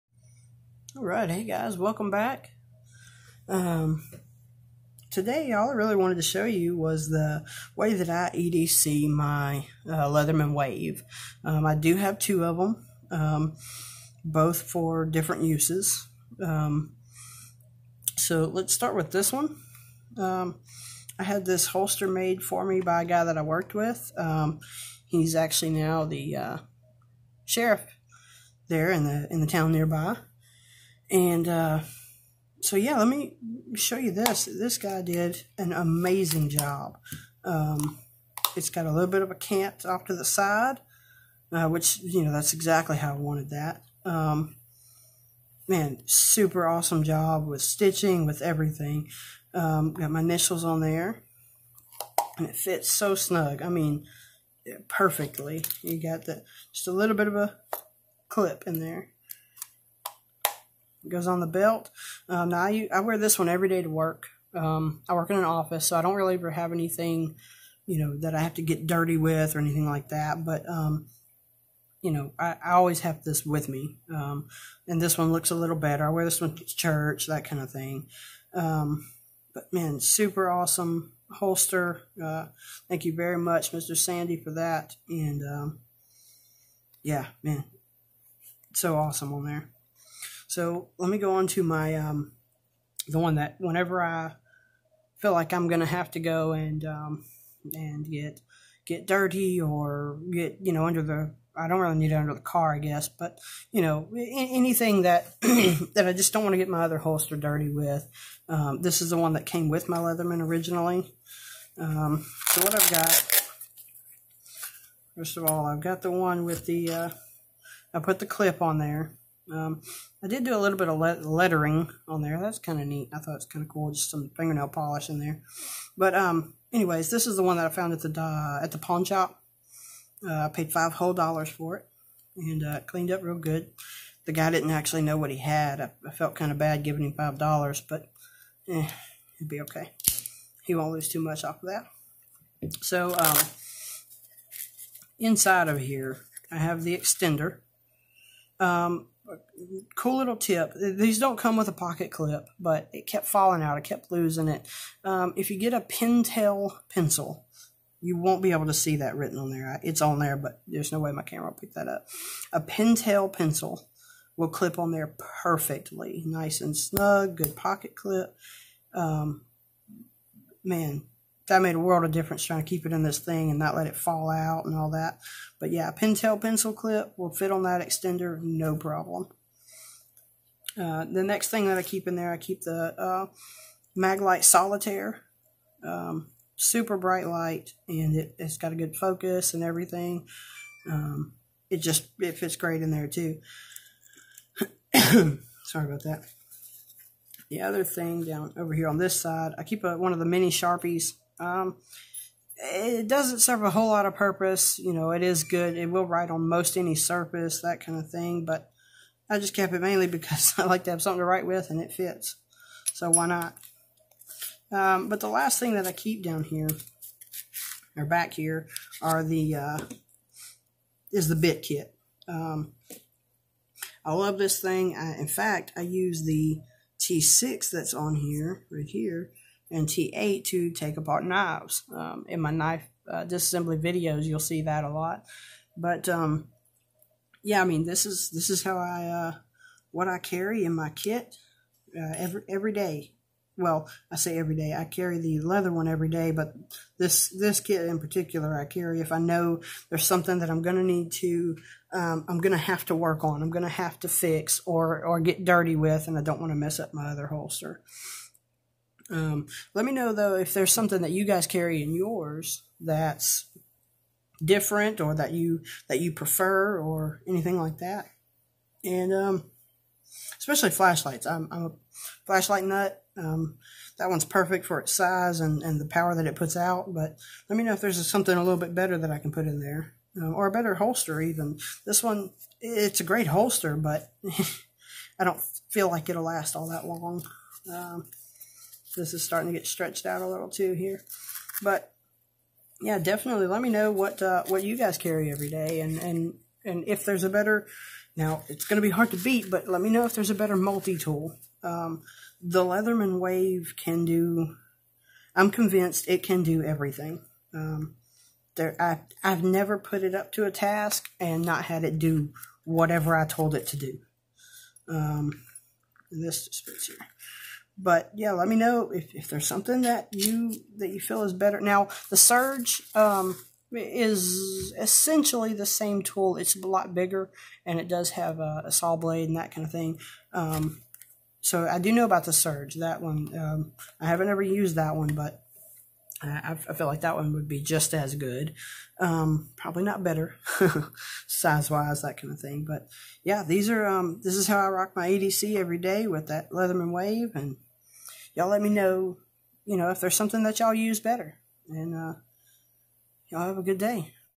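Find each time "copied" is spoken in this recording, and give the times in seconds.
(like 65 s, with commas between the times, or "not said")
not said.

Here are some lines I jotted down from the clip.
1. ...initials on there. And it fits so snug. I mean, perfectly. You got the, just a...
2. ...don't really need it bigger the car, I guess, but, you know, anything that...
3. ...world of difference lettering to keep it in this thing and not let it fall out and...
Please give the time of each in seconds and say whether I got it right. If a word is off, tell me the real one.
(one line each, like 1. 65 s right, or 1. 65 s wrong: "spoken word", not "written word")
1. 50 s right
2. 101 s wrong: "under", not "bigger"
3. 171 s wrong: "trying", not "lettering".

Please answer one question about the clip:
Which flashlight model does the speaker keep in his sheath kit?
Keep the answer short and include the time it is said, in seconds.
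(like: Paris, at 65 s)
Maglite Solitaire, at 183 s.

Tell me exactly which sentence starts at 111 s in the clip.
Um, so what I've got, first of all, I've got the one with the, uh, I put the clip on there.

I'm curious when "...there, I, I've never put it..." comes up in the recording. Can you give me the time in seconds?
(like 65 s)
308 s.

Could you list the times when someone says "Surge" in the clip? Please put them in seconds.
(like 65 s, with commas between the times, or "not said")
322 s, 332 s.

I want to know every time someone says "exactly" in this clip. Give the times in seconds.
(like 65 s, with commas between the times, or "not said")
42 s.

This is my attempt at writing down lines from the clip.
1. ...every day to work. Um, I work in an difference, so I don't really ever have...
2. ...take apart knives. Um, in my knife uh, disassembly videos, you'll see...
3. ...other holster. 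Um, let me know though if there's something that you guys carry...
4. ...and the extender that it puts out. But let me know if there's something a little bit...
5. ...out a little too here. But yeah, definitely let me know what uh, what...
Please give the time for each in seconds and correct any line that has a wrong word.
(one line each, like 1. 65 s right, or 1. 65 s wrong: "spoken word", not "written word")
1. 63 s wrong: "office", not "difference"
2. 230 s right
3. 257 s right
4. 275 s wrong: "power", not "extender"
5. 290 s right.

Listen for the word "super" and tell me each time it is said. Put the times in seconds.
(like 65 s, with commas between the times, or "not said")
46 s, 79 s, 186 s.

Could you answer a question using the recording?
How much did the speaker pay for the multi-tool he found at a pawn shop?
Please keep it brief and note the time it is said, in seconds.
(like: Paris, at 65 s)
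$5, at 130 s.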